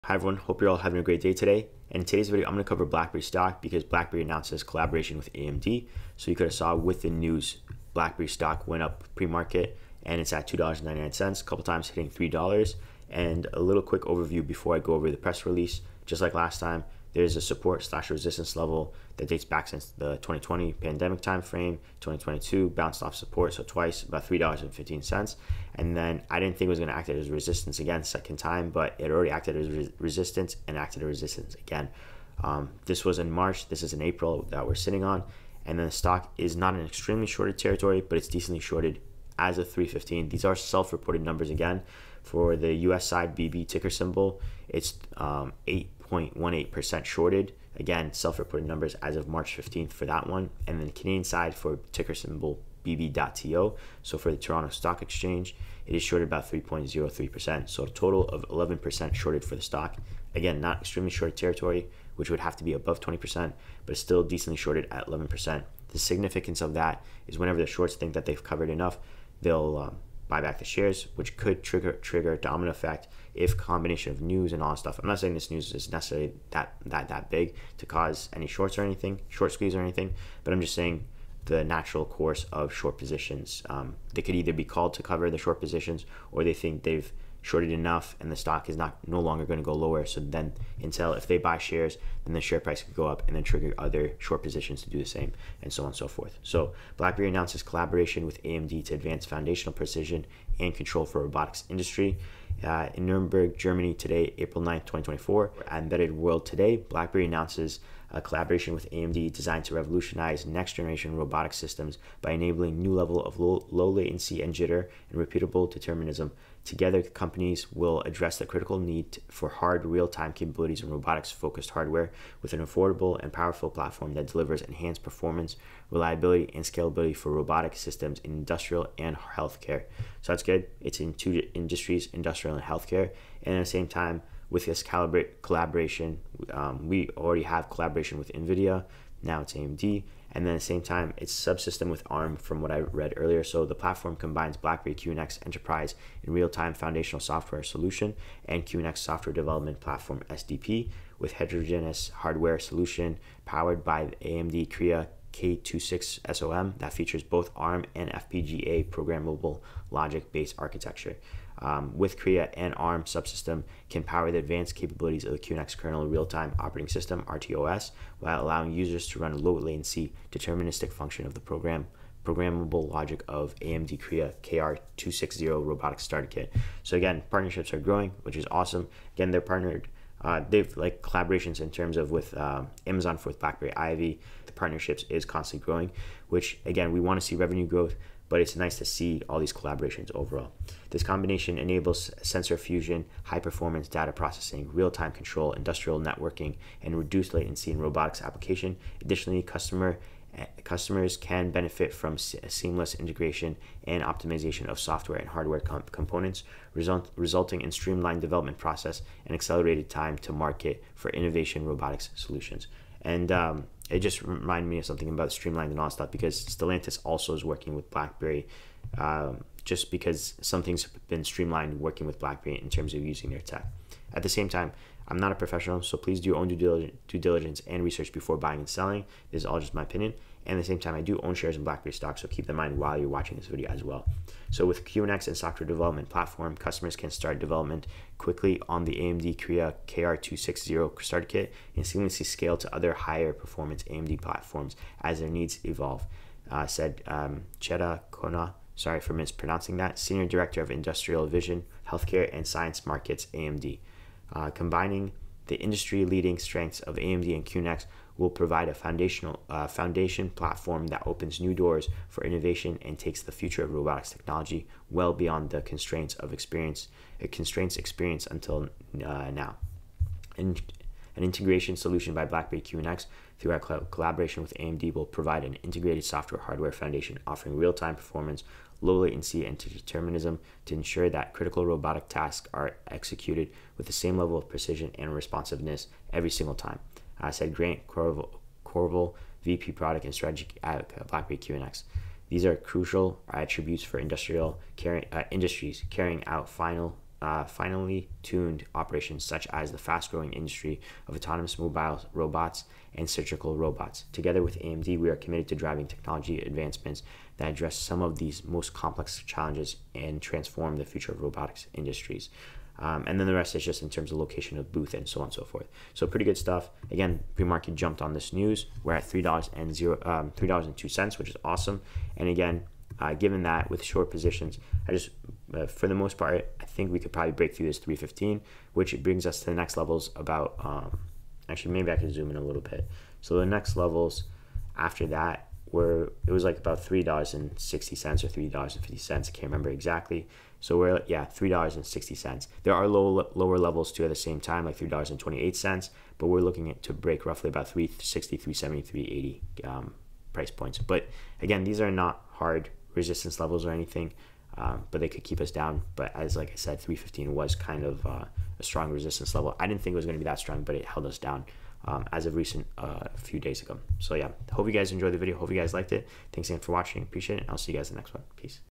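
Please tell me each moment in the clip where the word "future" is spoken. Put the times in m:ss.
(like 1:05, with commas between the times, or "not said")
4:23, 5:10.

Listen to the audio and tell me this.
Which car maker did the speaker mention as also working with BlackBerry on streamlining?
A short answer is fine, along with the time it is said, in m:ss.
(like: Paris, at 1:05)
Stellantis, at 3:36.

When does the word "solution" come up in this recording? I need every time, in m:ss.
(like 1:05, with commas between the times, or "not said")
2:27, 2:32, 3:32, 4:31.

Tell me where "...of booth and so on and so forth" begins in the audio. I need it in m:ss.
5:14.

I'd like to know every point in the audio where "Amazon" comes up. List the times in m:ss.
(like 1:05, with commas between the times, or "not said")
3:02.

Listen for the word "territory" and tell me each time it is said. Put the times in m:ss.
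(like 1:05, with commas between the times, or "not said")
0:37, 1:01.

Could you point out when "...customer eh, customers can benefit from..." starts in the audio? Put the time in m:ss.
3:19.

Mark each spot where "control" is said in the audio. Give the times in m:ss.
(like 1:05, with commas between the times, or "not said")
1:40, 3:15.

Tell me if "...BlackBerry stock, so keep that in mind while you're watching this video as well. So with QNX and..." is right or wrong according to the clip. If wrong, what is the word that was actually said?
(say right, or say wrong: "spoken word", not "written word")
right.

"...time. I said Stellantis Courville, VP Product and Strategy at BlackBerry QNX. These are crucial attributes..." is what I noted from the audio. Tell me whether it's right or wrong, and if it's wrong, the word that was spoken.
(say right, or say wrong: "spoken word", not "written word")
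wrong: "Grant", not "Stellantis".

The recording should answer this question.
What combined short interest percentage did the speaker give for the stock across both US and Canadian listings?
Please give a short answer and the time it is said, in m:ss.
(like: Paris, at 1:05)
11%, at 0:57.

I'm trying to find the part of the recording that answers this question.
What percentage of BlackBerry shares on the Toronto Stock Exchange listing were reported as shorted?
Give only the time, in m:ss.
0:56.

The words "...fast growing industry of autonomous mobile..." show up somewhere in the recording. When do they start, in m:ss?
4:59.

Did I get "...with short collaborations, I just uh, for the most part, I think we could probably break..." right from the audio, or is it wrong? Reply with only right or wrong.
wrong.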